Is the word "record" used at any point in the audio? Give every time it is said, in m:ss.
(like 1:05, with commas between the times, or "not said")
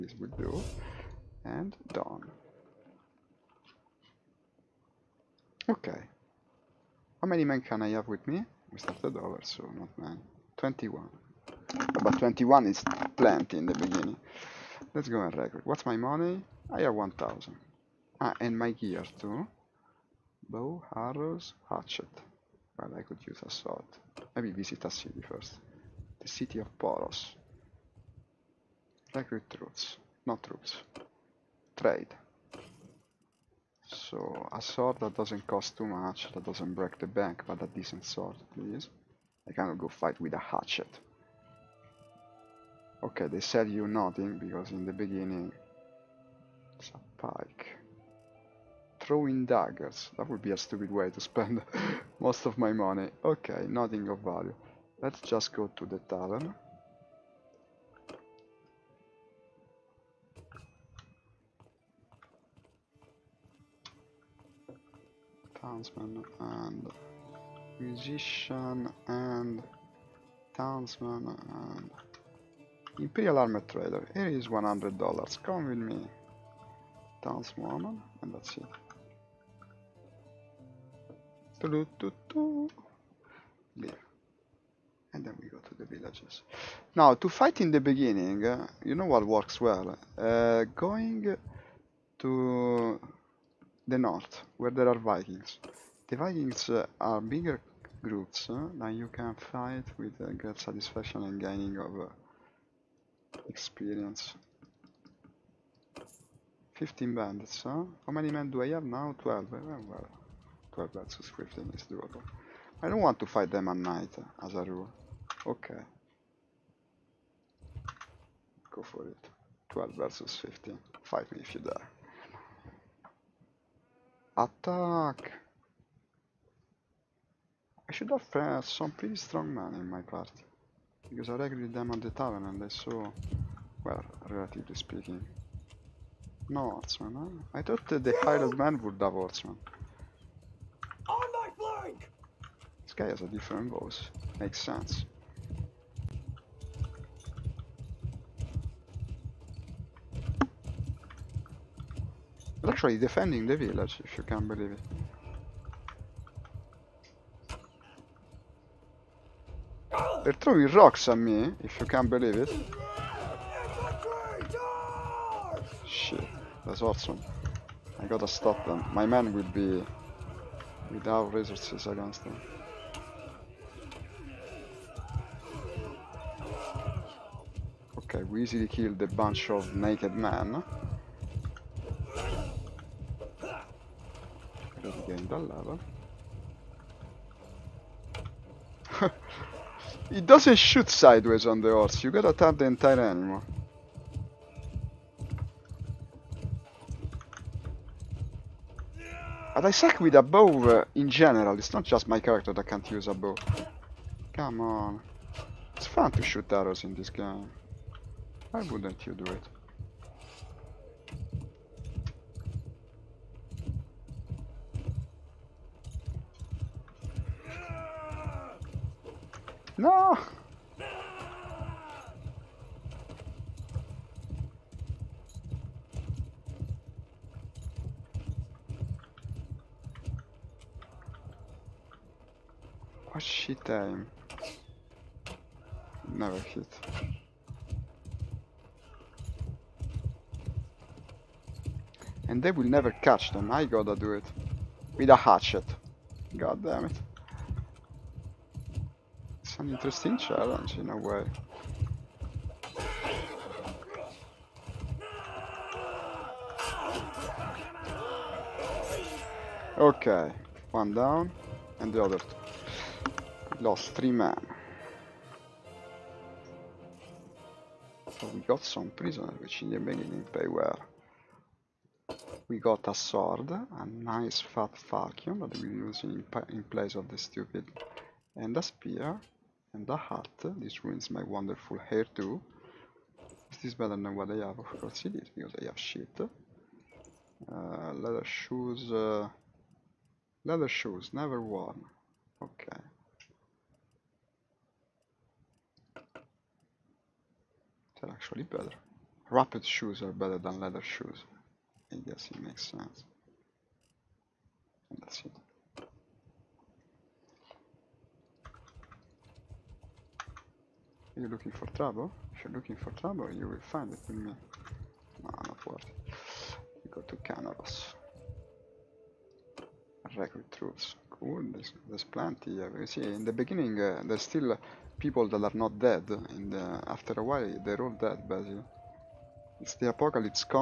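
0:15, 5:20.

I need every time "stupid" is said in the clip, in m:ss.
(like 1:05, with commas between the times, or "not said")
0:50, 4:37.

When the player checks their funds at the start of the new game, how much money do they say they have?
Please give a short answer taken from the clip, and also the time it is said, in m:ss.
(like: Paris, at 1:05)
1000, at 0:16.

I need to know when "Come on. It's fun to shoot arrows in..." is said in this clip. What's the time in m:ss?
3:24.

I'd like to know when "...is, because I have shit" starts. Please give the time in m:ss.
4:45.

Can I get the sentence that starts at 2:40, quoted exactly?
They're throwing rocks at me, if you can believe it.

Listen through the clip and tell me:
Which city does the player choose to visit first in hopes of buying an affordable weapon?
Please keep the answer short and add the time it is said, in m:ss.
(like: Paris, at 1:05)
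Poros, at 0:26.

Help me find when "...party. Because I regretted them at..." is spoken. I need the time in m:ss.
2:10.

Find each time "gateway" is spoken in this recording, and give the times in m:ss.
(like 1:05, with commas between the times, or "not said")
not said.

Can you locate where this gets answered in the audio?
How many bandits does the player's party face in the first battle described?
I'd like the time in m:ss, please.
1:46.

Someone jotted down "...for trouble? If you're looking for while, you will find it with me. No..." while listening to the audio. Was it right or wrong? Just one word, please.
wrong.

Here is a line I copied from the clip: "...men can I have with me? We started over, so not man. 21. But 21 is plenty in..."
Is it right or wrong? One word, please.
right.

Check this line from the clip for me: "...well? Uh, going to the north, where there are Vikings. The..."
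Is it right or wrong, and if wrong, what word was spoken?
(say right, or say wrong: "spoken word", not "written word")
right.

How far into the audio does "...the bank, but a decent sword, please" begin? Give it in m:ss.
0:36.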